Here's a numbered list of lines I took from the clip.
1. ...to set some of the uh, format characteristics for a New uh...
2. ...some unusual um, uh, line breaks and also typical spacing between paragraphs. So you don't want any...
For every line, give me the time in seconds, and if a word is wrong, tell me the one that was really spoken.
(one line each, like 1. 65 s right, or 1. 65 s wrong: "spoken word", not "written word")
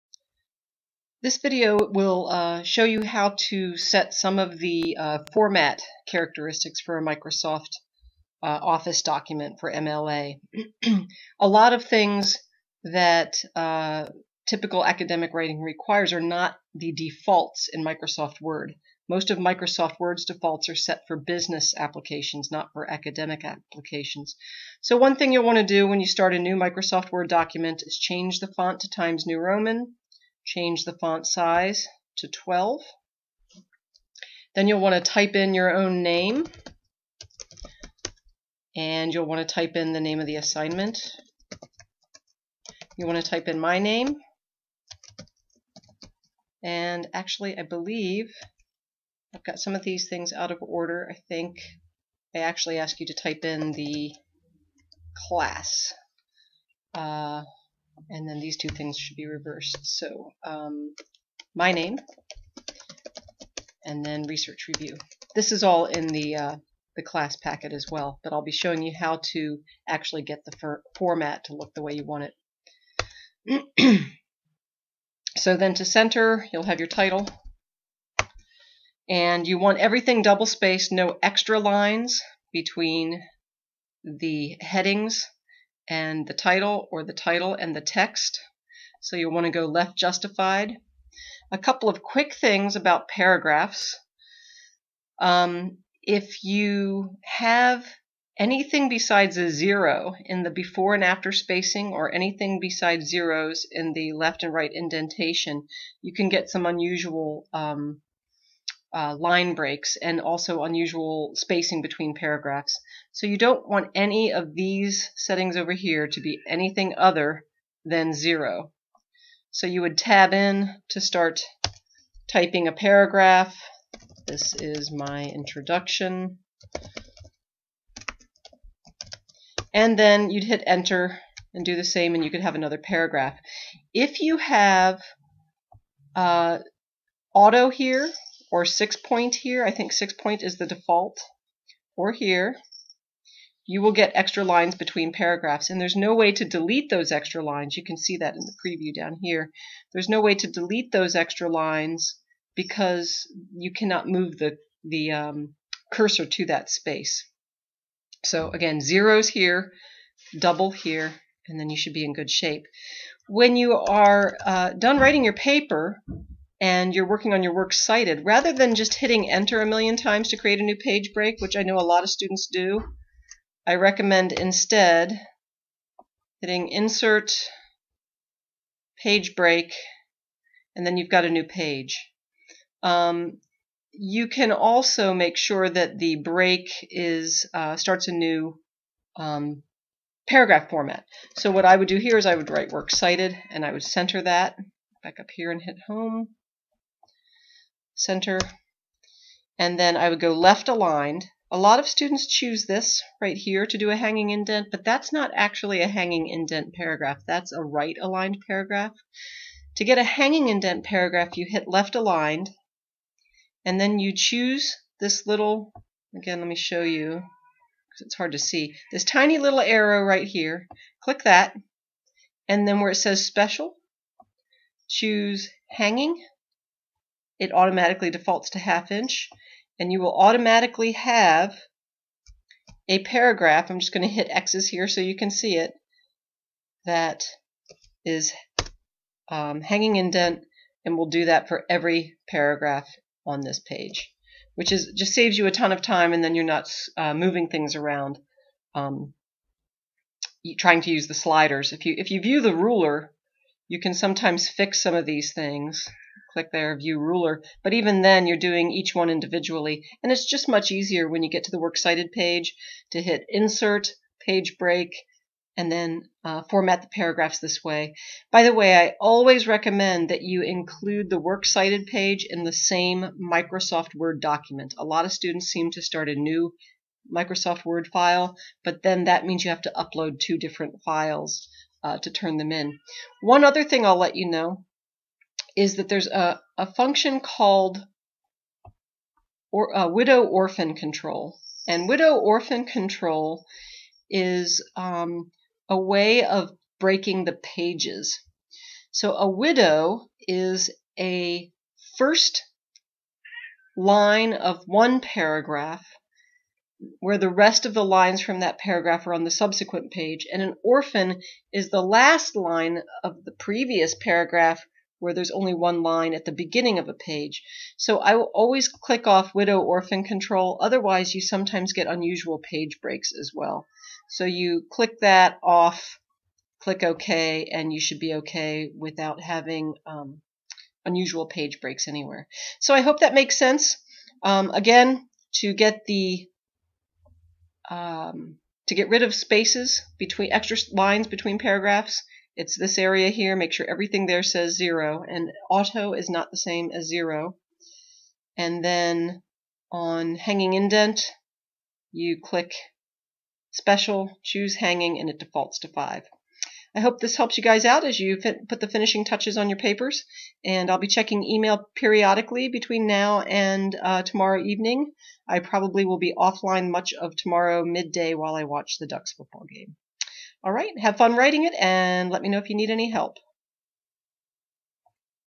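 1. 3 s wrong: "Microsoft", not "New"
2. 106 s wrong: "unusual", not "typical".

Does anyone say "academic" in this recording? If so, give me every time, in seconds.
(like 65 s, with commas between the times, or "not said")
14 s, 22 s.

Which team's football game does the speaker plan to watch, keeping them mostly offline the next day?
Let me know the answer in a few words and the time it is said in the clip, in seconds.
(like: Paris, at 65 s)
The Ducks, at 368 s.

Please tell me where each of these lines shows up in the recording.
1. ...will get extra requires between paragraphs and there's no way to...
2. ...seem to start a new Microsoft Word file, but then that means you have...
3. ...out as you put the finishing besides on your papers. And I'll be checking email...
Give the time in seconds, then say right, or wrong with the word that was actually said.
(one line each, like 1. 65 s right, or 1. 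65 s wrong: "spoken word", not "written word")
1. 143 s wrong: "lines", not "requires"
2. 275 s right
3. 357 s wrong: "touches", not "besides".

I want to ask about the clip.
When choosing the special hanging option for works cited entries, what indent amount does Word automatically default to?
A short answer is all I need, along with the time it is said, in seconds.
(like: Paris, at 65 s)
Half inch, at 228 s.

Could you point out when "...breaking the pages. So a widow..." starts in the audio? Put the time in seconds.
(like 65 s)
296 s.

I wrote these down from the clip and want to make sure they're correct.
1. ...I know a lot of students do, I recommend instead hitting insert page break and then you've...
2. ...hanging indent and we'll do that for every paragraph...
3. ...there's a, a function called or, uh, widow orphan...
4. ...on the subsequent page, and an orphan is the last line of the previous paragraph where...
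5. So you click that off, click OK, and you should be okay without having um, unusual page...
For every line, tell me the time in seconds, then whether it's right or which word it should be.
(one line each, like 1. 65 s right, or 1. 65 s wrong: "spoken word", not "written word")
1. 171 s right
2. 239 s right
3. 285 s right
4. 309 s right
5. 324 s right.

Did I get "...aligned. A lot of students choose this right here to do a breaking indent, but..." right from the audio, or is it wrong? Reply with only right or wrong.
wrong.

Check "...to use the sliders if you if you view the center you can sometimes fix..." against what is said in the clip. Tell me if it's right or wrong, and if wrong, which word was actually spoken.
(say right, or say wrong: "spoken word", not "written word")
wrong: "ruler", not "center".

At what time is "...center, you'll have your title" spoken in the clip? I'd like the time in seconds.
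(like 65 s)
75 s.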